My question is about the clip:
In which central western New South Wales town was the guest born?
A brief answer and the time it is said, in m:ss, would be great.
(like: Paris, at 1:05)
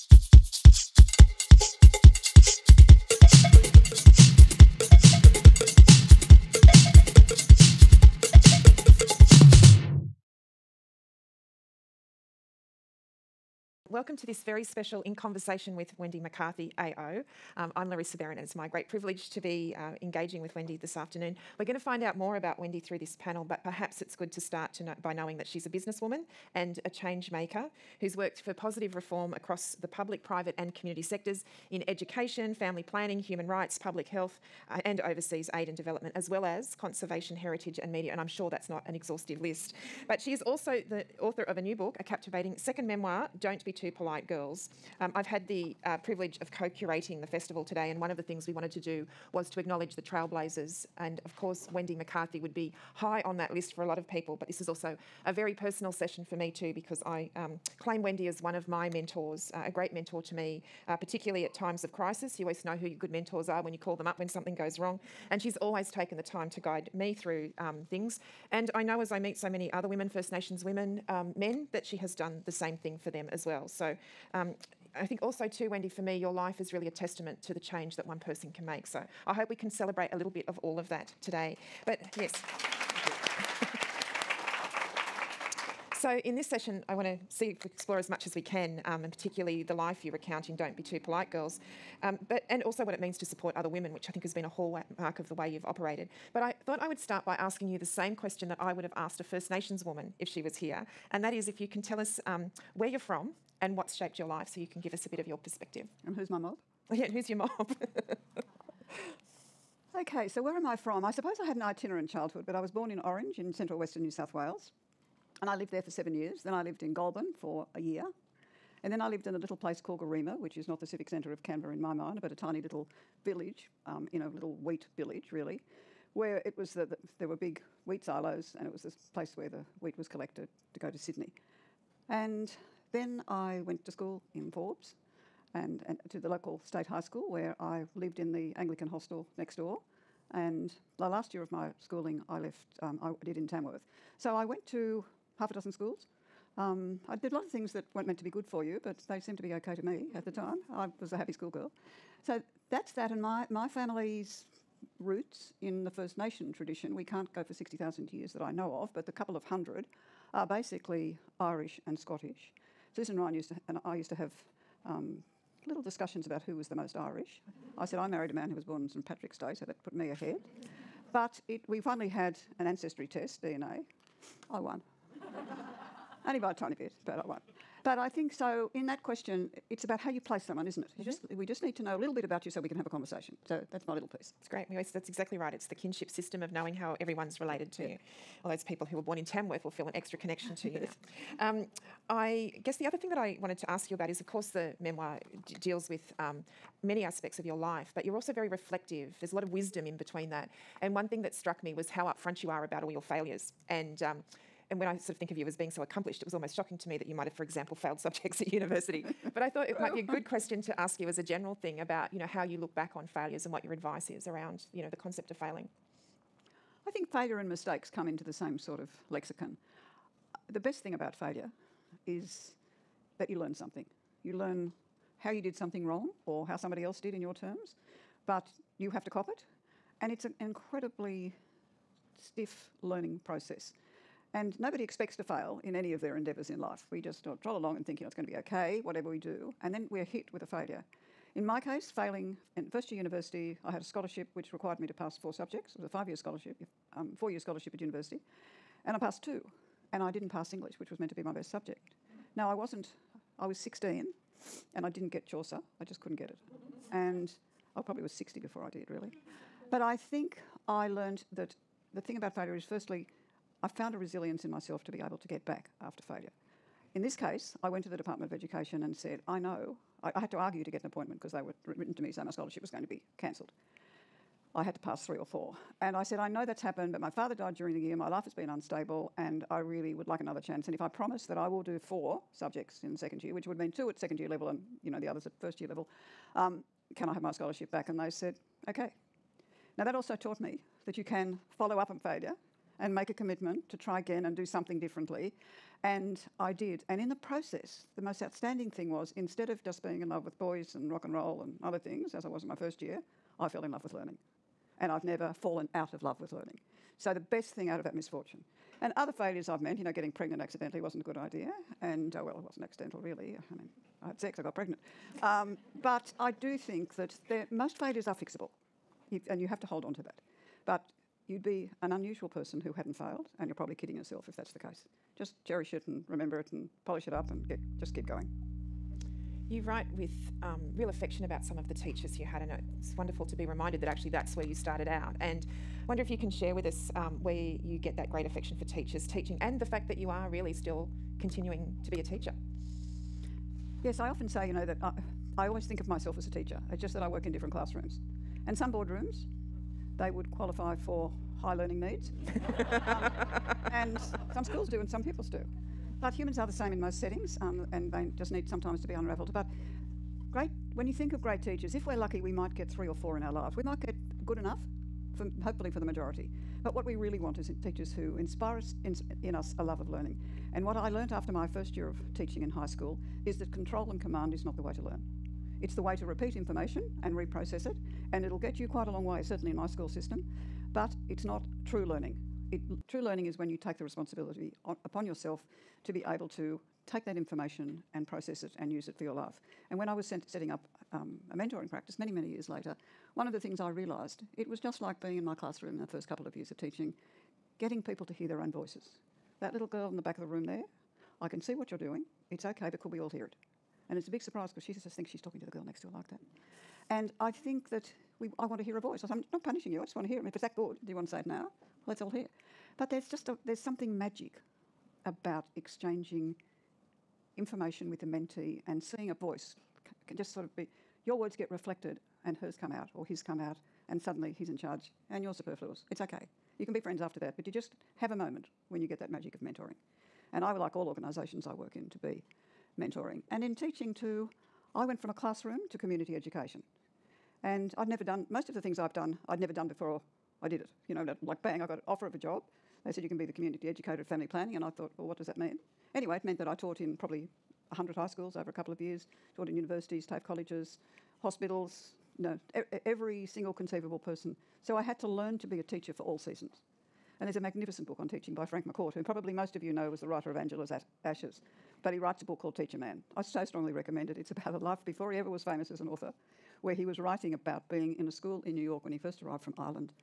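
Orange, at 1:52.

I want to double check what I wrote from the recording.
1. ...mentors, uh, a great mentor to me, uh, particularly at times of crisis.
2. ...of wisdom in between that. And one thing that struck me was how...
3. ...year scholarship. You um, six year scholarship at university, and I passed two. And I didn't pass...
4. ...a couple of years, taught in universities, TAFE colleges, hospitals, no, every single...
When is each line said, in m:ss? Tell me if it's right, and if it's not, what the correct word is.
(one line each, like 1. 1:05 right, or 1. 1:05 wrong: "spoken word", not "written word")
1. 0:58 right
2. 3:19 right
3. 4:06 wrong: "four", not "six"
4. 7:28 right.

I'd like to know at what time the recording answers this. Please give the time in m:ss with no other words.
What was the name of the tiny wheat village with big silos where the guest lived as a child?
1:59.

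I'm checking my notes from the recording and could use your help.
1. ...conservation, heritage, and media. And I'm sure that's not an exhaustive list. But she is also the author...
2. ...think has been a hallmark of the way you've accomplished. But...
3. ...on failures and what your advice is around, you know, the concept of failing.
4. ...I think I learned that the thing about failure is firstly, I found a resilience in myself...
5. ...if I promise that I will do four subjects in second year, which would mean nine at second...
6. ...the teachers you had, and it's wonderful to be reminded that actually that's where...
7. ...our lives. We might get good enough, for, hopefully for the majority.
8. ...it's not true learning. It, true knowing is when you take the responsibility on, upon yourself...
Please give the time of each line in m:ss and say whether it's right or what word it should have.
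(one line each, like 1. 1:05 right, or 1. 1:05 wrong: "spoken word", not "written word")
1. 0:36 right
2. 1:34 wrong: "operated", not "accomplished"
3. 3:32 right
4. 4:19 right
5. 4:40 wrong: "two", not "nine"
6. 5:31 right
7. 6:03 right
8. 6:21 wrong: "learning", not "knowing".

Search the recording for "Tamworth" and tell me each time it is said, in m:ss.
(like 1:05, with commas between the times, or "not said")
2:23, 3:09.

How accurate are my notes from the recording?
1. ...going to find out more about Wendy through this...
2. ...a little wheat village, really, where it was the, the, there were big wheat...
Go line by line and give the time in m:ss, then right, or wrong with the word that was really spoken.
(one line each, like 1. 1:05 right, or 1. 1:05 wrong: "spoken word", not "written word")
1. 0:21 right
2. 2:04 right.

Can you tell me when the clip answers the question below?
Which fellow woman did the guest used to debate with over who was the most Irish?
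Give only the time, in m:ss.
2:42.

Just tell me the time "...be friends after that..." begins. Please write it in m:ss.
7:06.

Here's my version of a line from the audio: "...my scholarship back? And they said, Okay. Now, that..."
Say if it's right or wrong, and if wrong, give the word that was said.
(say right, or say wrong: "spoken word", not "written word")
right.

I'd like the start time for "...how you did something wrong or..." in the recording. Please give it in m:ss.
3:45.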